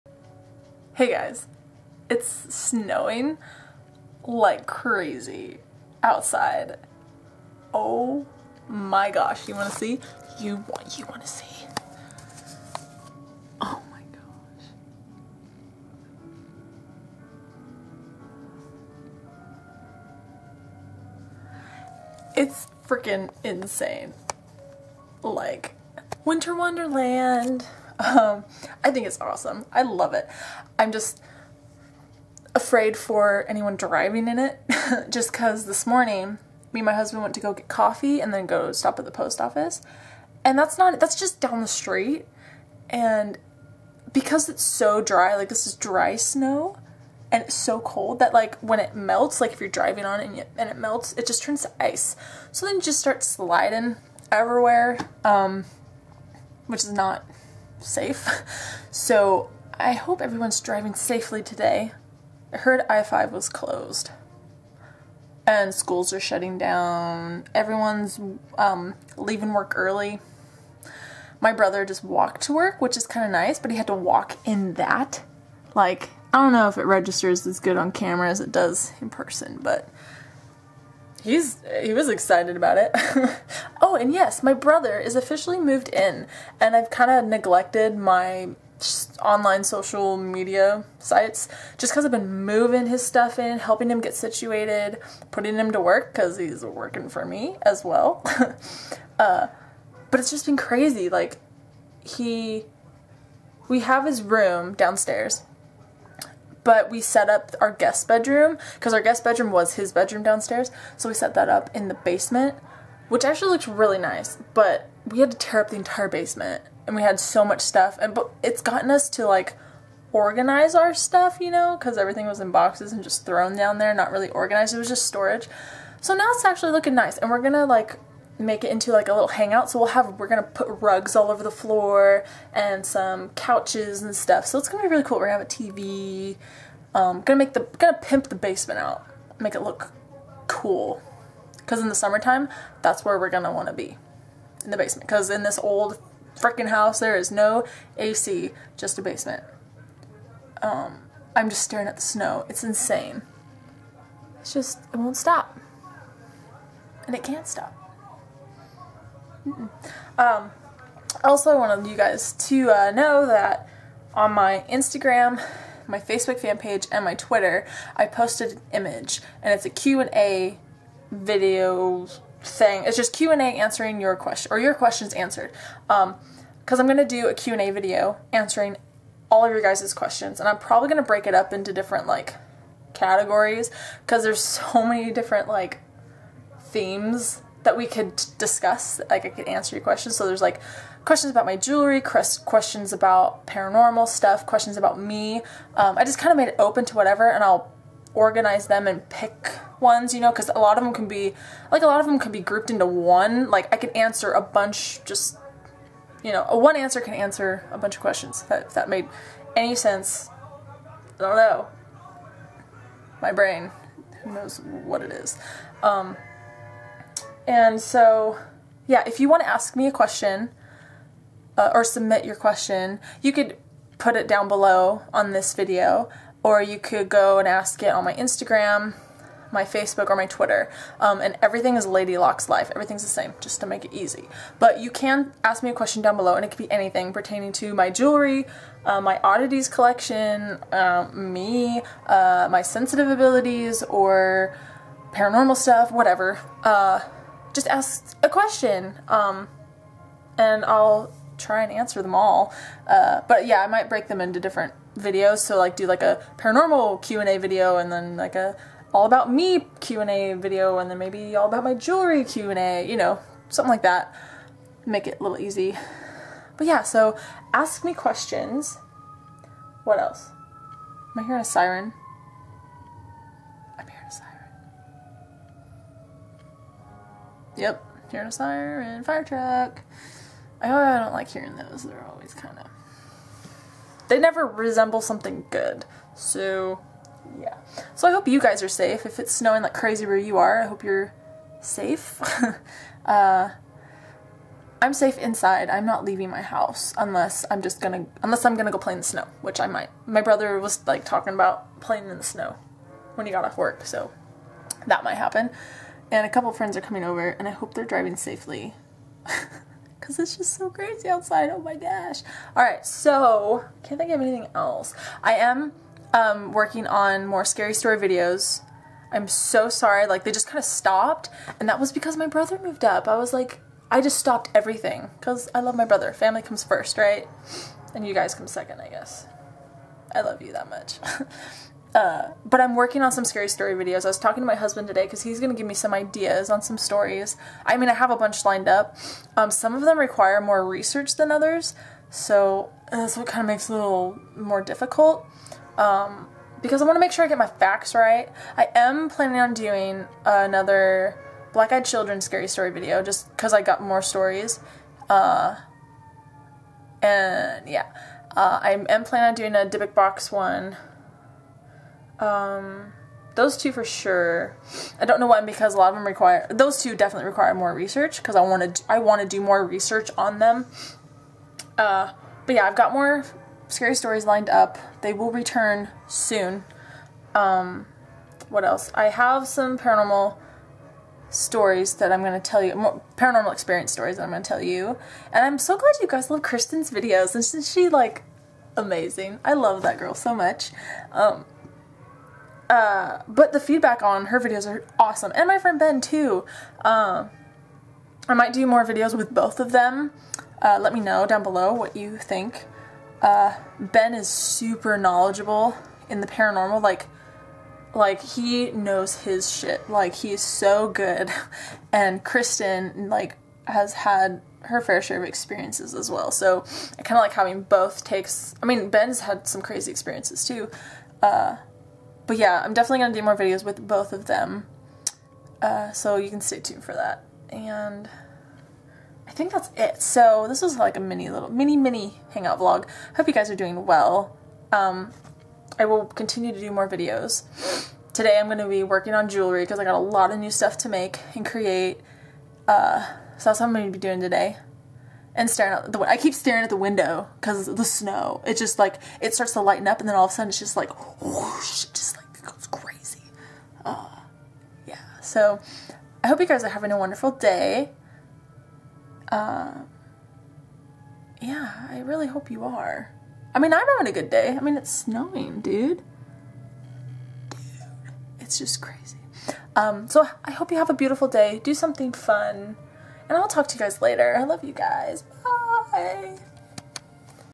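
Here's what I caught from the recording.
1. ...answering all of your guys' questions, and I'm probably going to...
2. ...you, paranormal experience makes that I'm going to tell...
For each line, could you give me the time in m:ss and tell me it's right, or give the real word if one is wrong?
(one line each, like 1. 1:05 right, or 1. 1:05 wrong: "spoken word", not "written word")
1. 2:58 right
2. 6:22 wrong: "stories", not "makes".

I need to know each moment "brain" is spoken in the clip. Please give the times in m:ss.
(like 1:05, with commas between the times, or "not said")
3:33.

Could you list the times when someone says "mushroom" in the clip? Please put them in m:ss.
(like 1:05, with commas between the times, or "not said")
not said.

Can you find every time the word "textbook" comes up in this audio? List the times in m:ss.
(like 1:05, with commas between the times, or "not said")
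not said.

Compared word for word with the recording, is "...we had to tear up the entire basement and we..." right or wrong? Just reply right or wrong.
right.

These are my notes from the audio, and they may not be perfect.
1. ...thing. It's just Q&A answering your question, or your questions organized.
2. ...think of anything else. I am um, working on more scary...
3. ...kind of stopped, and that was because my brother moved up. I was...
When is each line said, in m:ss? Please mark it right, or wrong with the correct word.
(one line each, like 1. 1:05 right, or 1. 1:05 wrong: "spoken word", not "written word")
1. 2:52 wrong: "answered", not "organized"
2. 5:13 right
3. 5:20 right.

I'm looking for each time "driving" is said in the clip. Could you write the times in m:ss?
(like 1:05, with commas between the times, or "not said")
0:33, 0:49, 1:00, 5:07.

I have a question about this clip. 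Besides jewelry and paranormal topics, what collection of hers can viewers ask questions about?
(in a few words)
Oddities collection.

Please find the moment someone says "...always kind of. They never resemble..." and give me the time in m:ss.
4:42.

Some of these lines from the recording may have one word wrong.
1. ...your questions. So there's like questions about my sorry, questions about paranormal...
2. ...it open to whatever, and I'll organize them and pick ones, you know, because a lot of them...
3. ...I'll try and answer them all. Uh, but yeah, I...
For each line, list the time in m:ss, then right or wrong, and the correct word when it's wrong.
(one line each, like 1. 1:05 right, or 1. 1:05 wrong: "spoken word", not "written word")
1. 3:09 wrong: "jewelry", not "sorry"
2. 3:16 right
3. 4:10 right.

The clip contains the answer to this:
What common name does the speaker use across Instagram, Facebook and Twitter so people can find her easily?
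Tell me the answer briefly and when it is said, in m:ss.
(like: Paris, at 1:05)
Lady Locks Life, at 3:51.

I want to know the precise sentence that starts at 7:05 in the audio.
Uh, so you can stay tuned for that.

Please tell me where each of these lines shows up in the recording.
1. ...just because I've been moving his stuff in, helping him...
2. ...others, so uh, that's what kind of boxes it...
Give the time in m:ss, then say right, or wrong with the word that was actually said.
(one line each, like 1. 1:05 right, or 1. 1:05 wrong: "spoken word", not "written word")
1. 1:31 right
2. 5:41 wrong: "makes", not "boxes".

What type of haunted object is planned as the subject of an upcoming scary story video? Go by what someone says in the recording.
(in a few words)
Dybbuk box.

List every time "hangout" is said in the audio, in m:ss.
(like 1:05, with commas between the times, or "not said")
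2:09, 7:12.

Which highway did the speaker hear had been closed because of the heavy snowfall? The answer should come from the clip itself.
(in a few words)
I-5.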